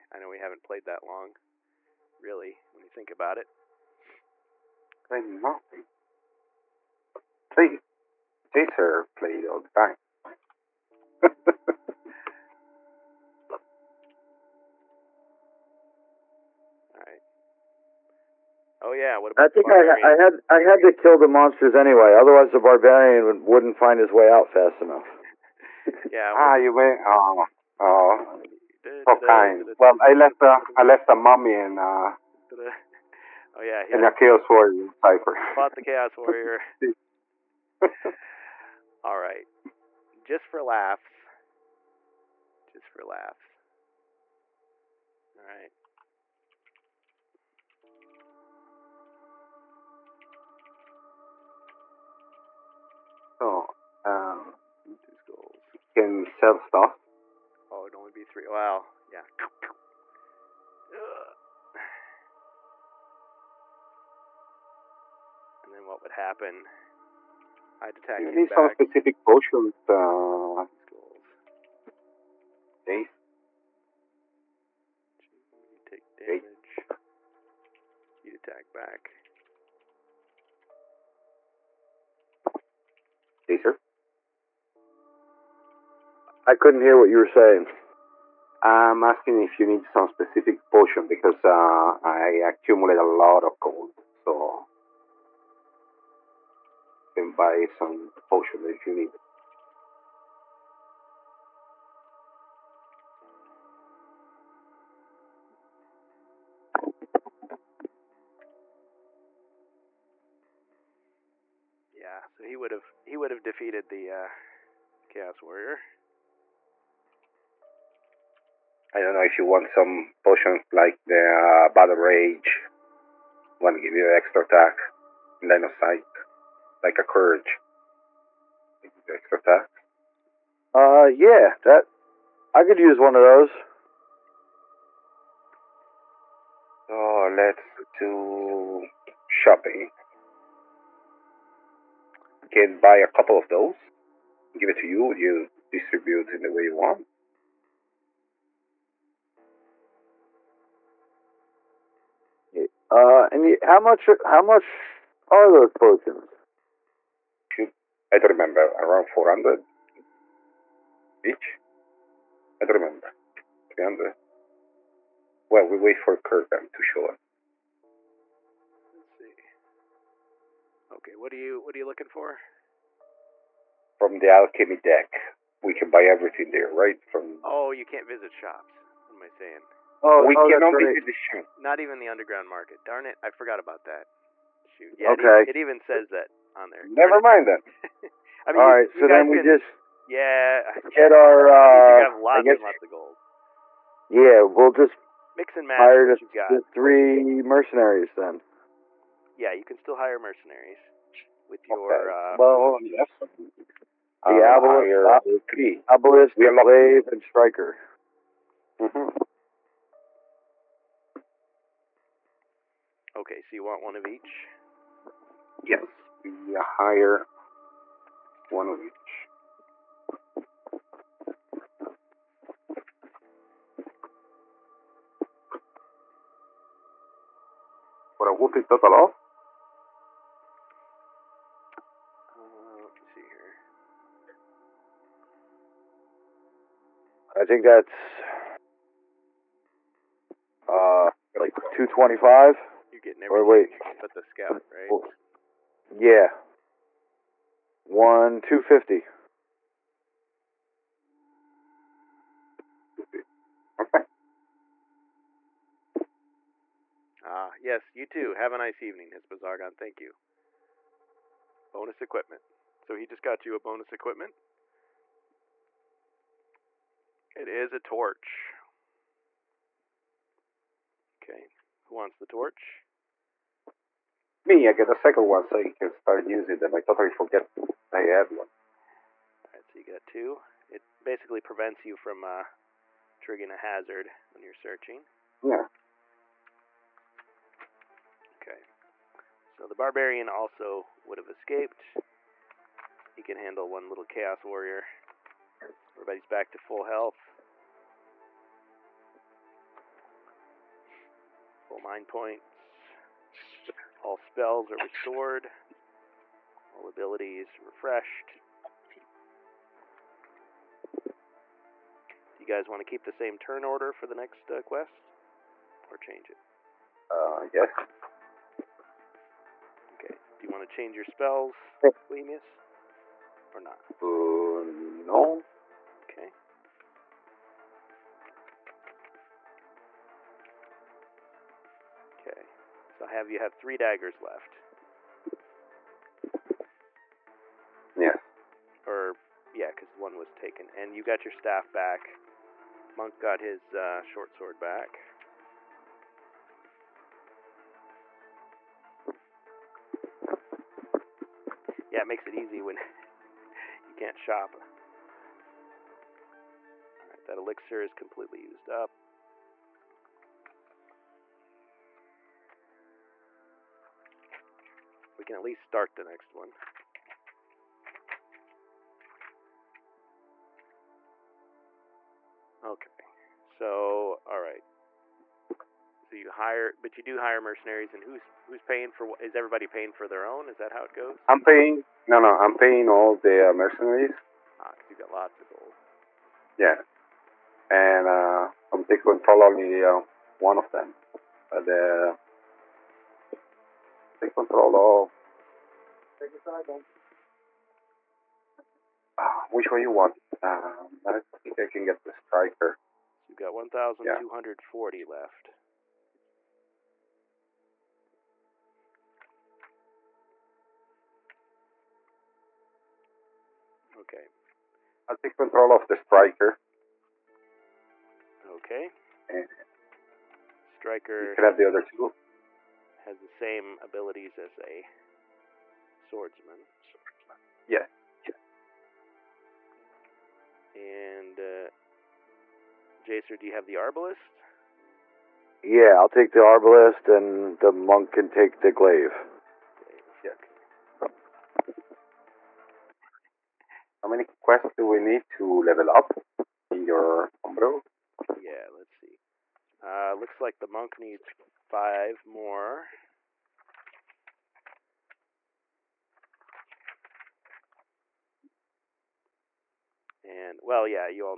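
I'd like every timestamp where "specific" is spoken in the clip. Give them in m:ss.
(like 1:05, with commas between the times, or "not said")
1:08, 1:30.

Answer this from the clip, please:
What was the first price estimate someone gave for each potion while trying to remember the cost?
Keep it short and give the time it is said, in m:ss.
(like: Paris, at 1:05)
400, at 2:39.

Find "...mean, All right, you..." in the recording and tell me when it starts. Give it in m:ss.
3:08.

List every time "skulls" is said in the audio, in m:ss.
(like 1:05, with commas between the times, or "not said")
0:55, 1:10.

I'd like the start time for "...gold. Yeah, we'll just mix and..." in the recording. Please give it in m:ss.
3:12.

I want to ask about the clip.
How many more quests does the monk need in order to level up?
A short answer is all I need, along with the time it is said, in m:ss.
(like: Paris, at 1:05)
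5, at 7:31.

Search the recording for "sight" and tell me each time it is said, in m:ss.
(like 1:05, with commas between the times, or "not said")
2:05.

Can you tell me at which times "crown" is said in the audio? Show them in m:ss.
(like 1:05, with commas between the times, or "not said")
not said.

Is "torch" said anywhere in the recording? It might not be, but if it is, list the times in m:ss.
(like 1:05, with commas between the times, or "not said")
4:27, 4:32.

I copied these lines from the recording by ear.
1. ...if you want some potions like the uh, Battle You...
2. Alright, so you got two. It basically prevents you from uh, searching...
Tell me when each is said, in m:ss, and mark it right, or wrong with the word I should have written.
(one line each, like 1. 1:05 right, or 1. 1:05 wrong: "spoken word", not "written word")
1. 1:59 wrong: "Rage", not "You"
2. 4:39 wrong: "triggering", not "searching".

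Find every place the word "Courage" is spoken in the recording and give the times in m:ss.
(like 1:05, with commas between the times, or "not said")
2:07.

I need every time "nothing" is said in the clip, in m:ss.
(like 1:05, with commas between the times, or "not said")
0:05.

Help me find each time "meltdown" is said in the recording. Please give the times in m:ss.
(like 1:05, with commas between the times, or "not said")
not said.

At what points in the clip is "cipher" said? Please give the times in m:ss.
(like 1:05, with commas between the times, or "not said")
0:35.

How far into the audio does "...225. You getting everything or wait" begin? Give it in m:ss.
4:01.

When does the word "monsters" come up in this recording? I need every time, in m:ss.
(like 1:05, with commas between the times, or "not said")
0:21.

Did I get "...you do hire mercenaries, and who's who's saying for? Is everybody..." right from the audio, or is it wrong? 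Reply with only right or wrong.
wrong.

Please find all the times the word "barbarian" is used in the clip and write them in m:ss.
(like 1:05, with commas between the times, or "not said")
0:22, 4:49.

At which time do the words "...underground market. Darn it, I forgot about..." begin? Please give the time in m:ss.
3:02.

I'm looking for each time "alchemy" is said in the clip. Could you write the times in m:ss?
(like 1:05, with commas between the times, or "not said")
2:54.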